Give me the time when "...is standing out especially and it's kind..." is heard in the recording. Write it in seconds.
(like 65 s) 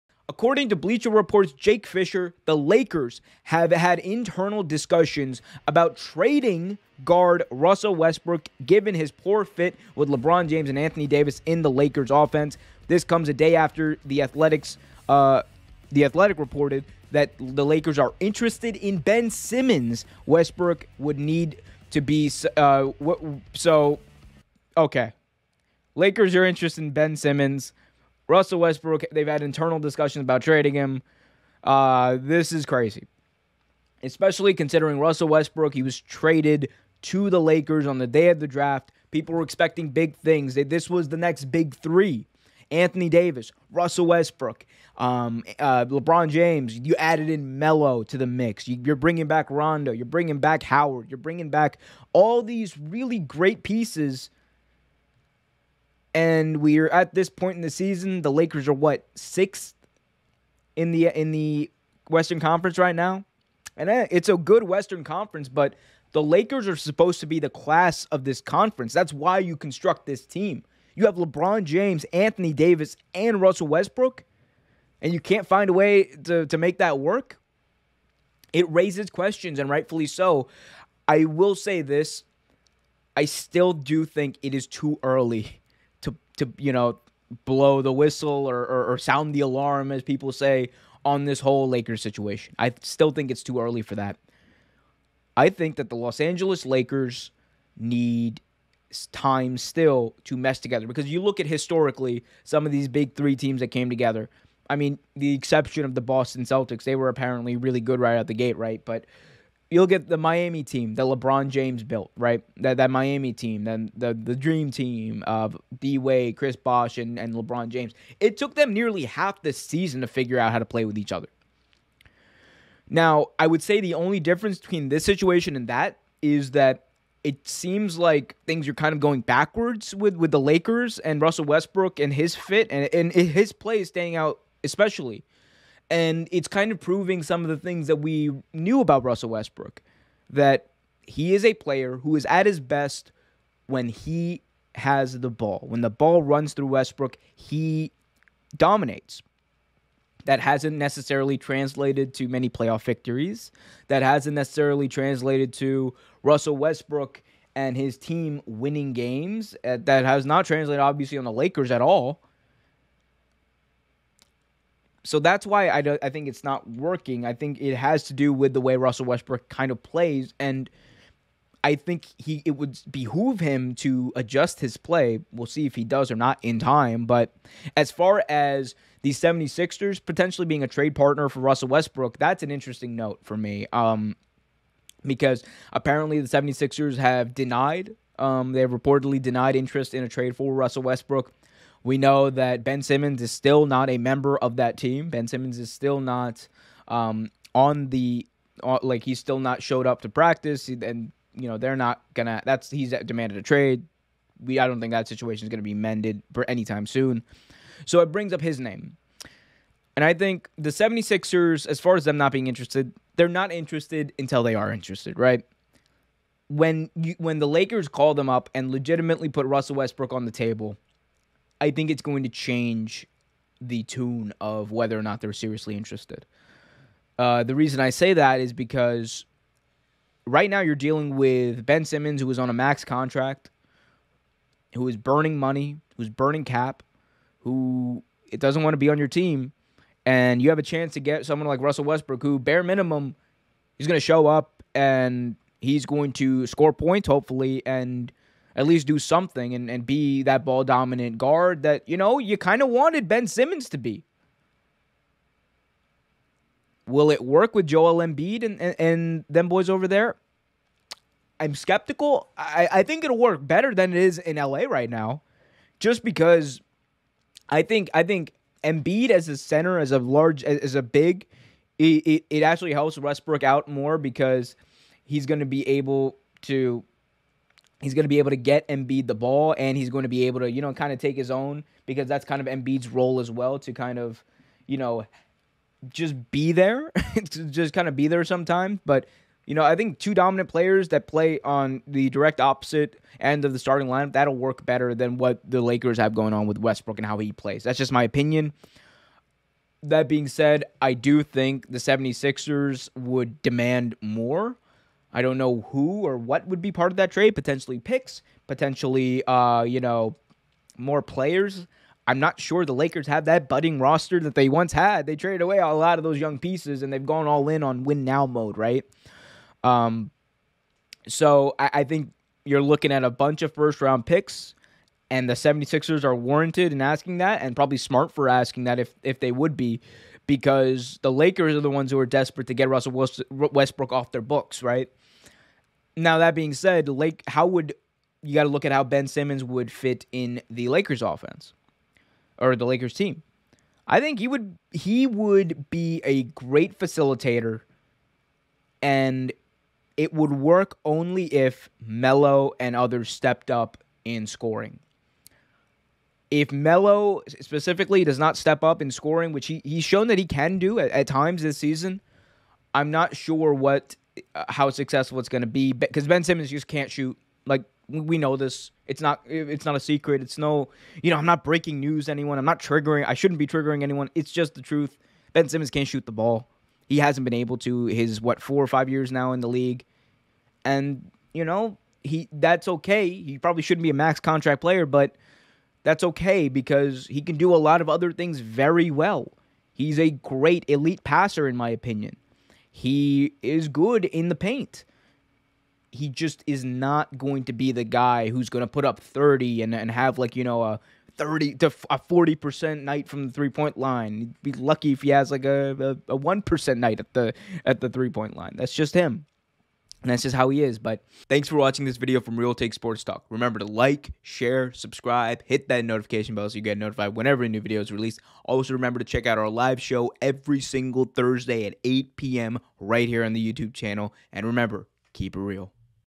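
133 s.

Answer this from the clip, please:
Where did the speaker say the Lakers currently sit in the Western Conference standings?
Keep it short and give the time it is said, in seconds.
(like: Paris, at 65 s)
Sixth, at 59 s.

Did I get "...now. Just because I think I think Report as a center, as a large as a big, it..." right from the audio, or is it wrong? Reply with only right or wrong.
wrong.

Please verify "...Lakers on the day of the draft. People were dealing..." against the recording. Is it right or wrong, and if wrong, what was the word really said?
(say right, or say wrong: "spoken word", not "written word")
wrong: "expecting", not "dealing".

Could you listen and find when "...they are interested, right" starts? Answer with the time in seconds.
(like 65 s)
214 s.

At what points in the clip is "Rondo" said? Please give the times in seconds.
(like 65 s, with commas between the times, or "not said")
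49 s.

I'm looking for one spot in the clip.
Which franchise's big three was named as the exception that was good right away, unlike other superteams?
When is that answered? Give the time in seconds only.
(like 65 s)
106 s.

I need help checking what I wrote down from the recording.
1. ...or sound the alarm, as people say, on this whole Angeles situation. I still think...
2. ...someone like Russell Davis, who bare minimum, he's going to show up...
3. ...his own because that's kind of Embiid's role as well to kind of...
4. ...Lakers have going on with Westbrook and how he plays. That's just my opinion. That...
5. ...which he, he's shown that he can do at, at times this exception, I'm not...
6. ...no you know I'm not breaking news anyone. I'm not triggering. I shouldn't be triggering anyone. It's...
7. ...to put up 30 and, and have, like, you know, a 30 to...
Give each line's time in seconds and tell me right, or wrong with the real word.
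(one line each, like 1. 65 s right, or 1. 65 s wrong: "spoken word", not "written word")
1. 88 s wrong: "Lakers", not "Angeles"
2. 241 s wrong: "Westbrook", not "Davis"
3. 281 s right
4. 295 s right
5. 359 s wrong: "season", not "exception"
6. 370 s right
7. 398 s right.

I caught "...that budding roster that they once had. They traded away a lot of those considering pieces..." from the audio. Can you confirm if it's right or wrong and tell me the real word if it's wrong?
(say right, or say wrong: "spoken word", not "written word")
wrong: "young", not "considering".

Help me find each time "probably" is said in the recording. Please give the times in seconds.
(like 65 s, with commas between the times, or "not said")
327 s, 383 s.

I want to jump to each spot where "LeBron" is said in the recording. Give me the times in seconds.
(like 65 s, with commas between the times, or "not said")
10 s, 45 s, 71 s, 111 s, 117 s.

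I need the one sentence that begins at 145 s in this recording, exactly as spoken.
When the ball runs through Westbrook, he dominates.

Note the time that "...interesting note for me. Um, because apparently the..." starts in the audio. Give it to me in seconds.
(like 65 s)
182 s.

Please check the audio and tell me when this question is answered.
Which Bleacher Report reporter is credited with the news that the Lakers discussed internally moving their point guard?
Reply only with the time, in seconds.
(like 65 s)
1 s.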